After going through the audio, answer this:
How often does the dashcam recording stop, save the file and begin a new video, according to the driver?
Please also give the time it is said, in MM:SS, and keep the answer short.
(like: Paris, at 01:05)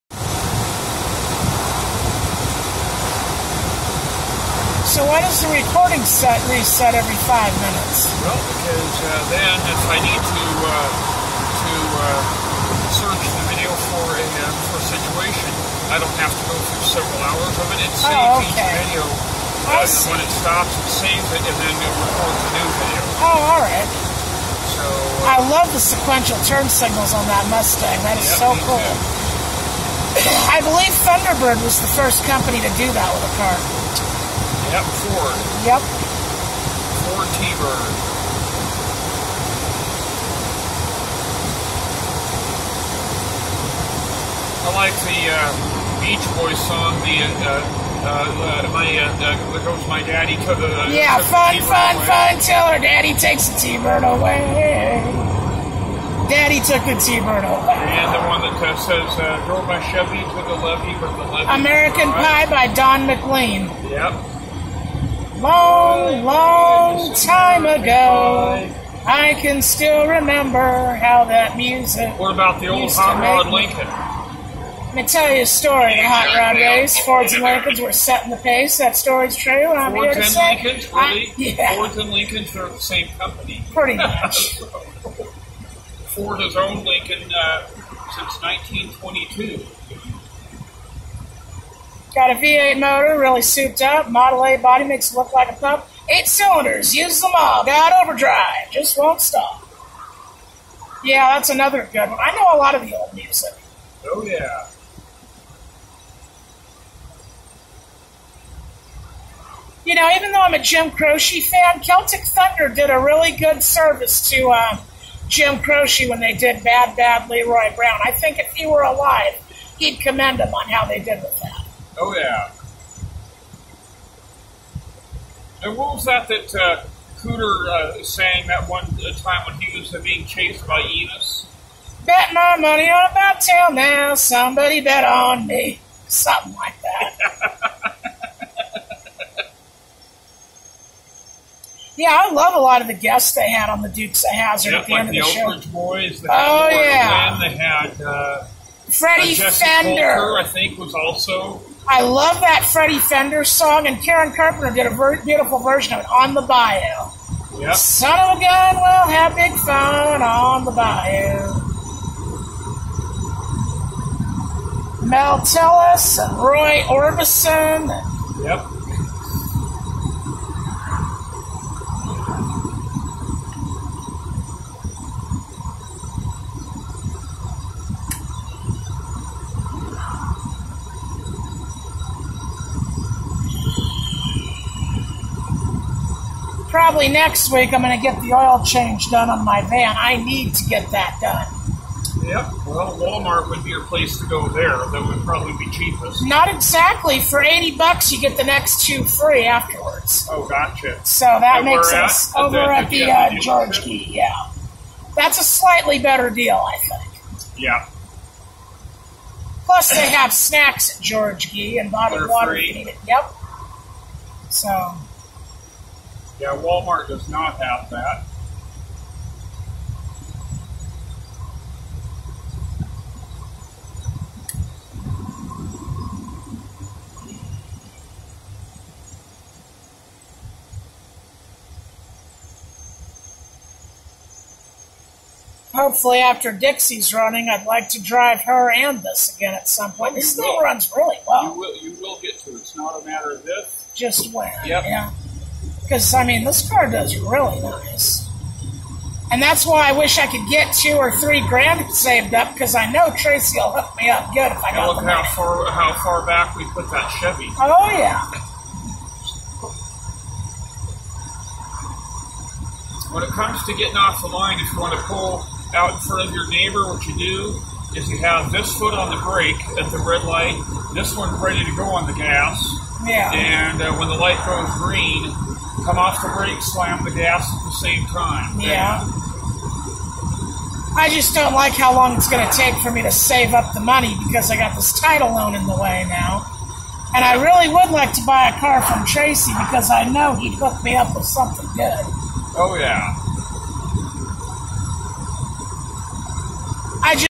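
Every 5 minutes, at 00:06.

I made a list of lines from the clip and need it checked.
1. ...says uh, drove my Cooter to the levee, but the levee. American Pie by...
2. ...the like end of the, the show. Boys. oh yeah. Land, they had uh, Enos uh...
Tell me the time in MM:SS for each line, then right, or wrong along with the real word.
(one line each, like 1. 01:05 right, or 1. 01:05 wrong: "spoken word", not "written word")
1. 00:58 wrong: "Chevy", not "Cooter"
2. 02:24 wrong: "Freddie", not "Enos".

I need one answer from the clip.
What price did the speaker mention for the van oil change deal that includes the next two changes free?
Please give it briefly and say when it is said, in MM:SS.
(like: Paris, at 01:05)
$80, at 03:17.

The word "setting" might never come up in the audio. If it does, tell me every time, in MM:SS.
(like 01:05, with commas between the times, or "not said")
01:17.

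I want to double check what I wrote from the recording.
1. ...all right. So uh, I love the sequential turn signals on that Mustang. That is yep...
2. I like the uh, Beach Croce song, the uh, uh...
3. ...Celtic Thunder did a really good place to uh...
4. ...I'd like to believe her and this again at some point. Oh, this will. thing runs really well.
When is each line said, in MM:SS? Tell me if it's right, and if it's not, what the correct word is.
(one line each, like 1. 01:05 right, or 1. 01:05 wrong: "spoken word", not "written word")
1. 00:23 right
2. 00:44 wrong: "Boys", not "Croce"
3. 01:51 wrong: "service", not "place"
4. 03:57 wrong: "drive", not "believe".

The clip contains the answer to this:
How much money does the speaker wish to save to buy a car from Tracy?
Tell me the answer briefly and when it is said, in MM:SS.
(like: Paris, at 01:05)
2 or 3 grand, at 04:10.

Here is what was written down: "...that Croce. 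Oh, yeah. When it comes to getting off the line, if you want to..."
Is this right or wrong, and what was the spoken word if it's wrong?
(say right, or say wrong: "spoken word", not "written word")
wrong: "Chevy", not "Croce".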